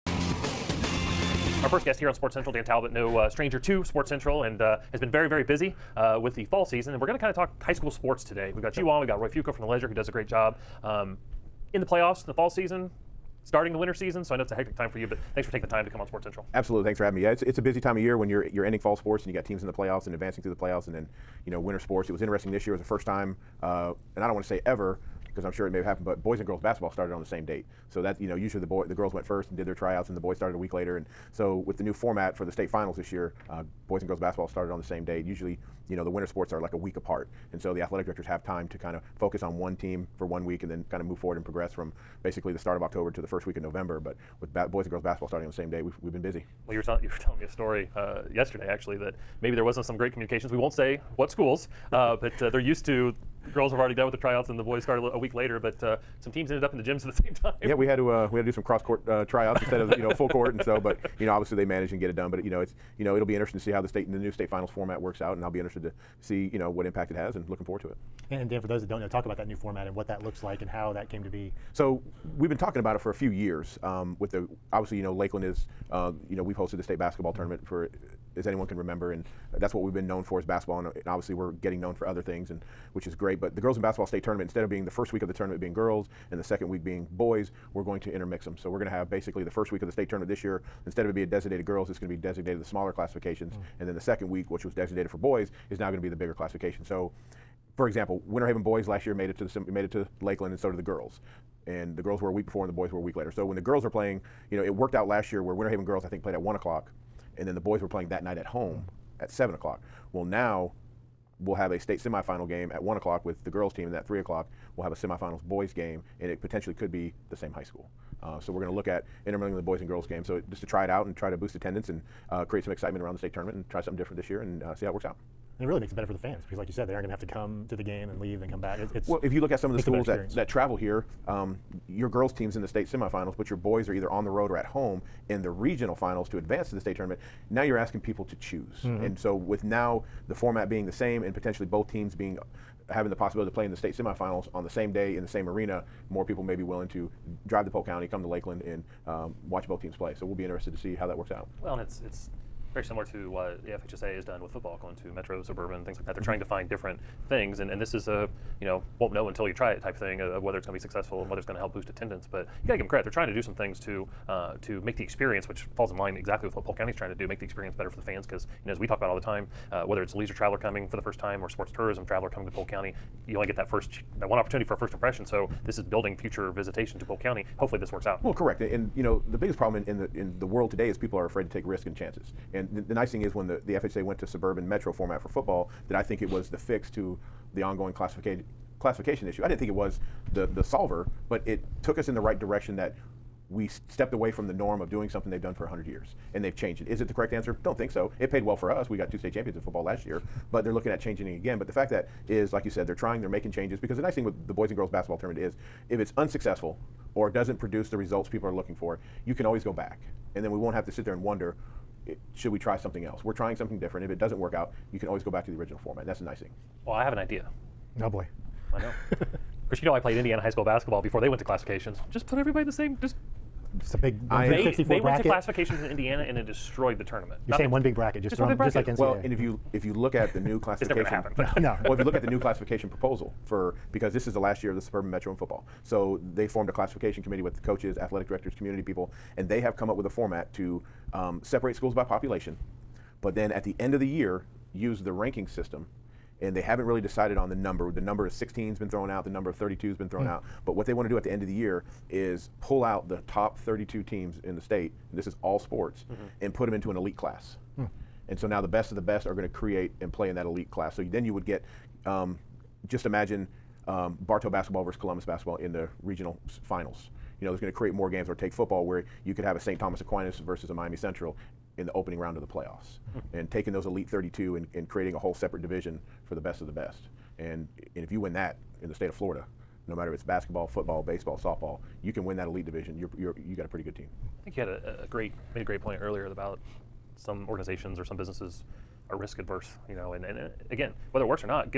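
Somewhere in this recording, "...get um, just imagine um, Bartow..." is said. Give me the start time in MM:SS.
04:21.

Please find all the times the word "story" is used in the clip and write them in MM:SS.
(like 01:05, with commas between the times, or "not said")
00:47.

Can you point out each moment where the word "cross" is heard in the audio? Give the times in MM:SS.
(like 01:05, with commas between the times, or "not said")
00:58.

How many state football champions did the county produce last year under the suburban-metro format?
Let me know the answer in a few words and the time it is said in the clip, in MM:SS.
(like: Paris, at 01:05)
2, at 03:19.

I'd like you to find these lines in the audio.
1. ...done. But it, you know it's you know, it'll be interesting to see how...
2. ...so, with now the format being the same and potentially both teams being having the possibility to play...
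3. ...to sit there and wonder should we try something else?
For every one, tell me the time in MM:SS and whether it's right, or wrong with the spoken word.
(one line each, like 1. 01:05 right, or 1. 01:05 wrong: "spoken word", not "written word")
1. 01:02 right
2. 02:19 right
3. 03:30 right.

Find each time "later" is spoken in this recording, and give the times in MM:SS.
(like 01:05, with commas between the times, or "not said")
00:30, 00:55, 01:43.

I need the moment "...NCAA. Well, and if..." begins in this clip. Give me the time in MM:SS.
03:48.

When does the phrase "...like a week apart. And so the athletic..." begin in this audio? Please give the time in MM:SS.
00:36.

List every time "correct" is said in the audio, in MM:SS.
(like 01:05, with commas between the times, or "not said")
02:58, 03:17.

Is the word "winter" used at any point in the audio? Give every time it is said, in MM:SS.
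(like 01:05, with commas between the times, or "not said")
00:13, 00:21, 00:36, 01:38, 01:45.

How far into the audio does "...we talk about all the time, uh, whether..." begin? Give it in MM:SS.
02:48.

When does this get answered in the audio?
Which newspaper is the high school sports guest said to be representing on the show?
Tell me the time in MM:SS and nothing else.
00:09.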